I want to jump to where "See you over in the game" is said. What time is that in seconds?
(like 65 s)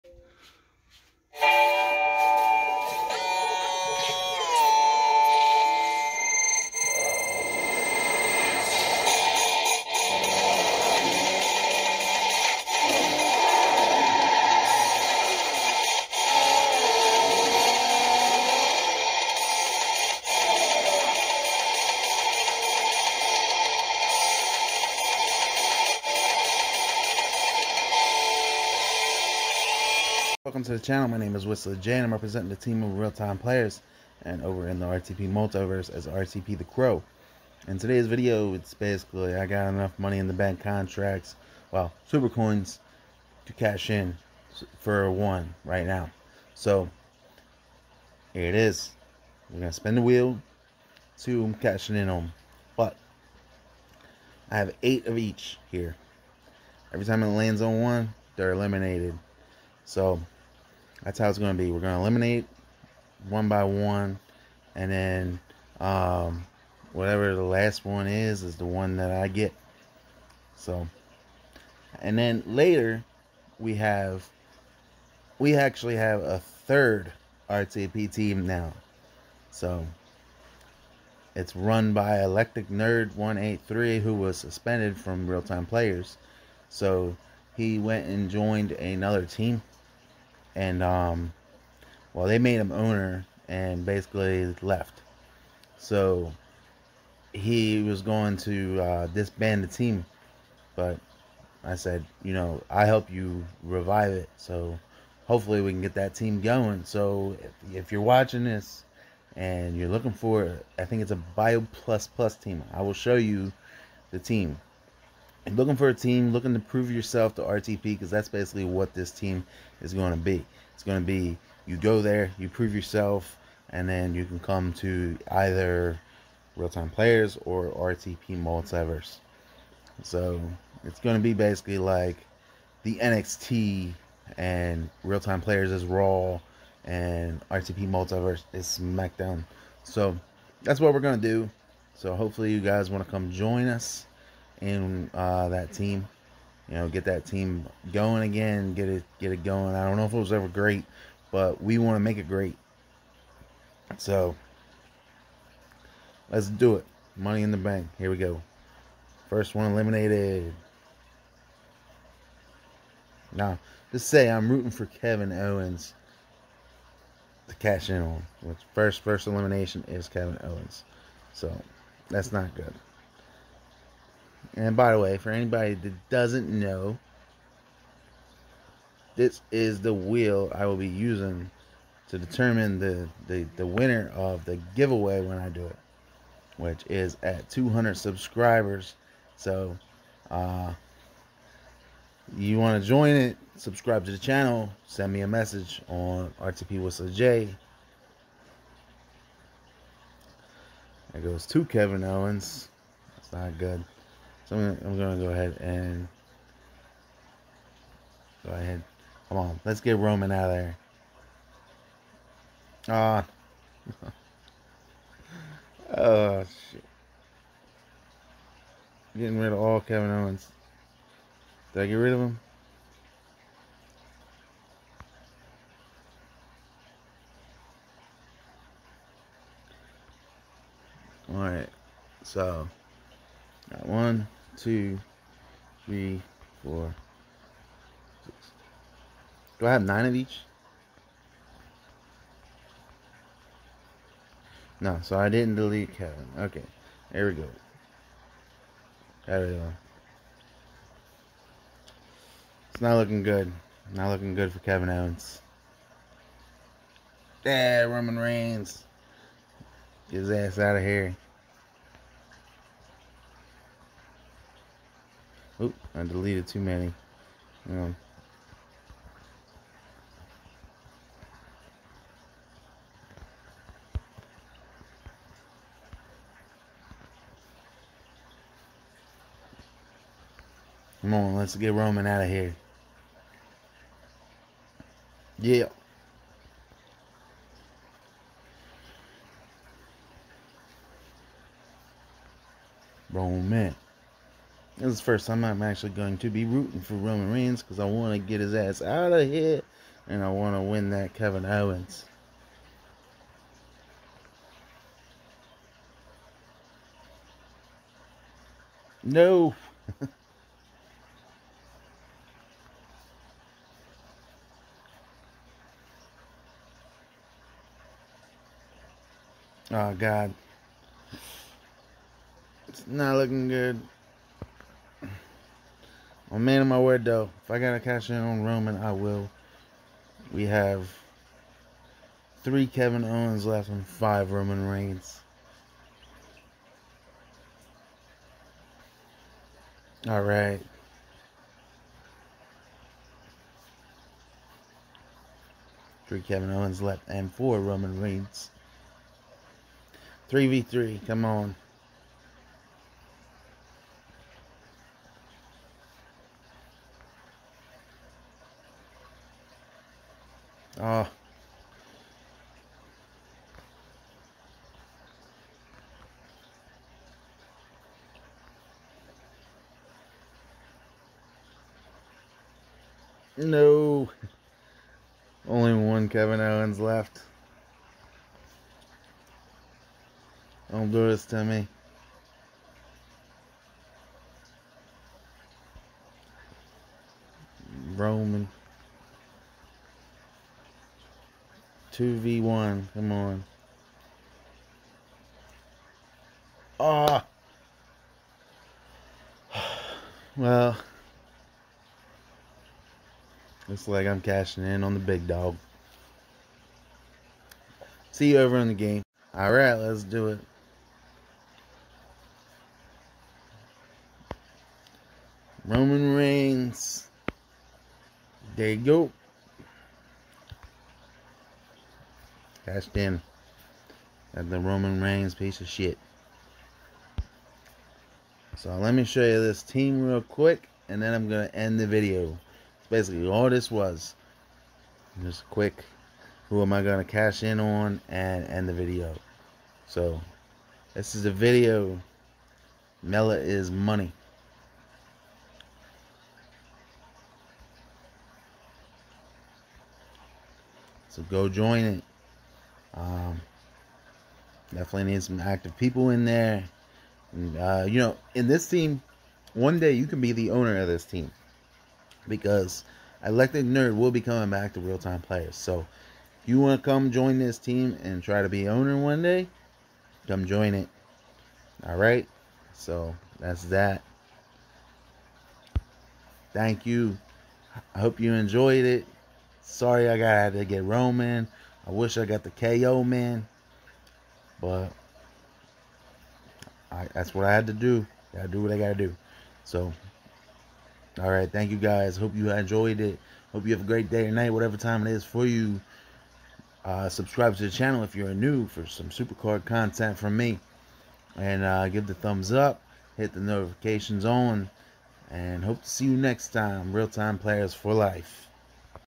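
408 s.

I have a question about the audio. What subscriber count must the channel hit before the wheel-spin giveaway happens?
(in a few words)
200.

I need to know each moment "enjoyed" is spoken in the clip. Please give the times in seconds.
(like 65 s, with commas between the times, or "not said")
478 s, 492 s.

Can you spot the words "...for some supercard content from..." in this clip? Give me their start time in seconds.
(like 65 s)
498 s.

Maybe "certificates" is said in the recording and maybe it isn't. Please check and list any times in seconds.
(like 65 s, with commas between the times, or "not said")
not said.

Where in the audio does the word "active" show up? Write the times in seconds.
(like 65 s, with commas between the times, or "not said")
455 s.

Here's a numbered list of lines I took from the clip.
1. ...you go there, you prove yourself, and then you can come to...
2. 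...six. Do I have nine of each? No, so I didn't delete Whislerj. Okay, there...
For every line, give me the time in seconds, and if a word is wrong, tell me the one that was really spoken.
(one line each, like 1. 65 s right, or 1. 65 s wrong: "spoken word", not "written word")
1. 121 s right
2. 238 s wrong: "Kevin", not "Whislerj".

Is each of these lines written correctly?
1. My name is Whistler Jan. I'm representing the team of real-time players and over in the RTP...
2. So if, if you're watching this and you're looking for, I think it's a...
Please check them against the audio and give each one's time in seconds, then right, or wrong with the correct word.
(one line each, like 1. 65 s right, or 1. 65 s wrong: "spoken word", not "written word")
1. 31 s right
2. 106 s right.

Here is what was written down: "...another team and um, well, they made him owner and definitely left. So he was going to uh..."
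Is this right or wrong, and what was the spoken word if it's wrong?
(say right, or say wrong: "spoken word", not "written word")
wrong: "basically", not "definitely".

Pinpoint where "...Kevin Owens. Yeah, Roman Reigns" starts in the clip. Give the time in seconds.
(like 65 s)
254 s.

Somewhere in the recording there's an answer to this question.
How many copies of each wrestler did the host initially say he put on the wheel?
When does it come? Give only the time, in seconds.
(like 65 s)
54 s.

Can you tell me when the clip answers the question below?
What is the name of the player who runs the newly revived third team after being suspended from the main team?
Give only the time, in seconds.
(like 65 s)
82 s.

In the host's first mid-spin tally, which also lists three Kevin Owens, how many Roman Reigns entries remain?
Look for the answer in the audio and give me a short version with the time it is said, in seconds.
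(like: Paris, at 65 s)
5, at 333 s.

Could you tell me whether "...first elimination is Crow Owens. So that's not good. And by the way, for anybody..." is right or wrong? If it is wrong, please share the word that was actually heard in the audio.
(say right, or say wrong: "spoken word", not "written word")
wrong: "Kevin", not "Crow".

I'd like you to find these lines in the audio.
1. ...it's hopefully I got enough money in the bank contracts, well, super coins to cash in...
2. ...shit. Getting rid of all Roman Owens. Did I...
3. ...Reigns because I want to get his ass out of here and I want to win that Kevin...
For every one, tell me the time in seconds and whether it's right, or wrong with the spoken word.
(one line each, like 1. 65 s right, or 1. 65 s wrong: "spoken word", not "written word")
1. 38 s wrong: "basically", not "hopefully"
2. 216 s wrong: "Kevin", not "Roman"
3. 297 s right.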